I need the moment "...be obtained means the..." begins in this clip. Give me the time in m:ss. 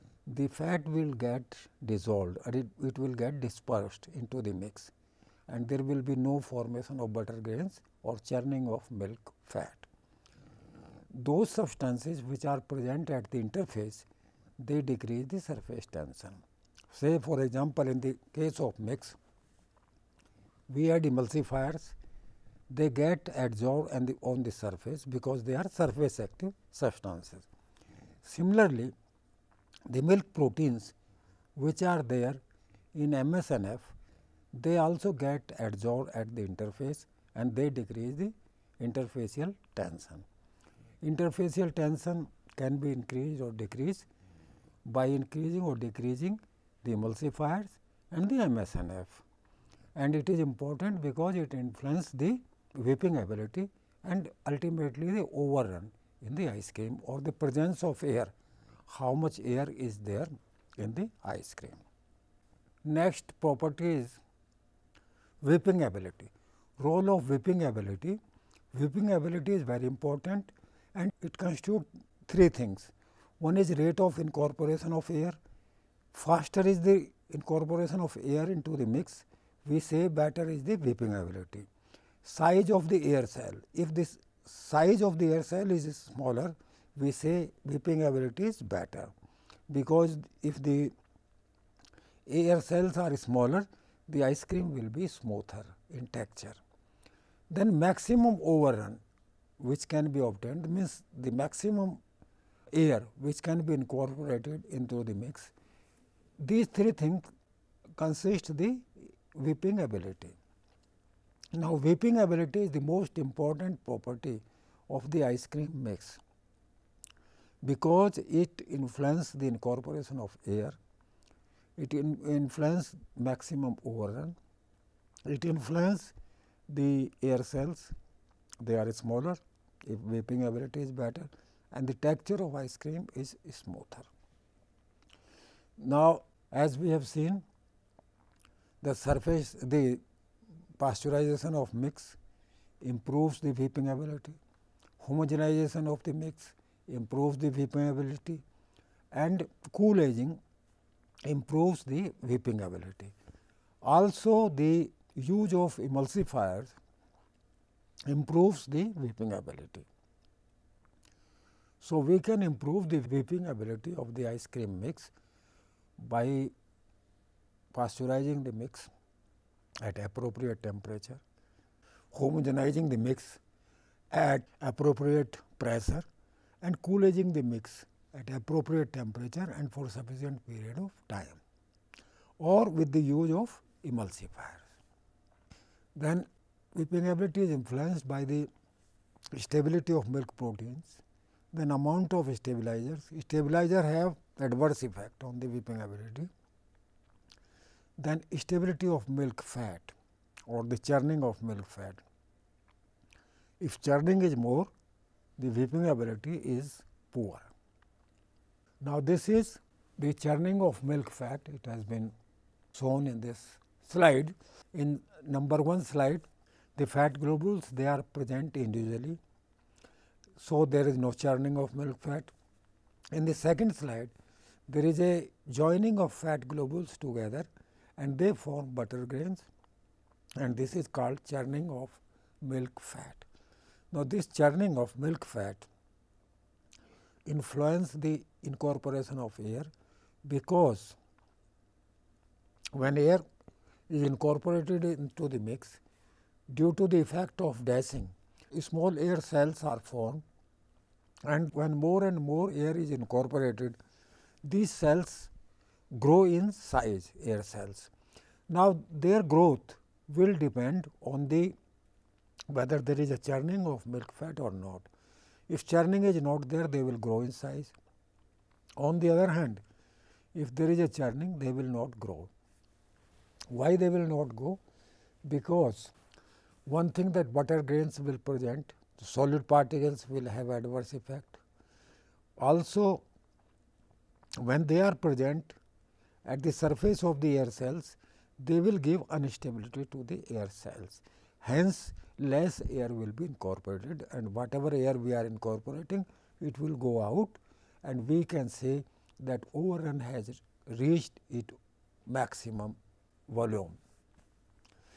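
1:40.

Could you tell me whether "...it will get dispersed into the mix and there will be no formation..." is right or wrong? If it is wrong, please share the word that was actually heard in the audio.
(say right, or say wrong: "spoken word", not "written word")
right.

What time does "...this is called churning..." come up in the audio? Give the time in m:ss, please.
3:50.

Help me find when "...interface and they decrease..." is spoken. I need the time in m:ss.
0:36.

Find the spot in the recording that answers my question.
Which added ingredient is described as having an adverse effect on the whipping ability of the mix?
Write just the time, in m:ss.
3:13.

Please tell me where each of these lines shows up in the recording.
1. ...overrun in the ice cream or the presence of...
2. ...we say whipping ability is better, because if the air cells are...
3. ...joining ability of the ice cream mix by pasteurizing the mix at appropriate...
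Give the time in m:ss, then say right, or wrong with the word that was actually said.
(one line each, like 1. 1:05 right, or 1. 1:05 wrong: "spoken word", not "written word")
1. 0:55 right
2. 1:26 right
3. 2:42 wrong: "whipping", not "joining".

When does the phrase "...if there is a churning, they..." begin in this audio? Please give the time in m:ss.
4:30.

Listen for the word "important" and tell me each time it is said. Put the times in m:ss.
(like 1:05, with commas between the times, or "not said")
0:50, 1:09, 1:53.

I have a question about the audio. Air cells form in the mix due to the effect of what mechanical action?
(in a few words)
Dashing.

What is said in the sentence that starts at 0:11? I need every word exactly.
Those substances which are present at the interface, they decrease the surface tension.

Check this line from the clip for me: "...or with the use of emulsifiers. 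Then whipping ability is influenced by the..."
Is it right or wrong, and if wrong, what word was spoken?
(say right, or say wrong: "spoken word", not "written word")
right.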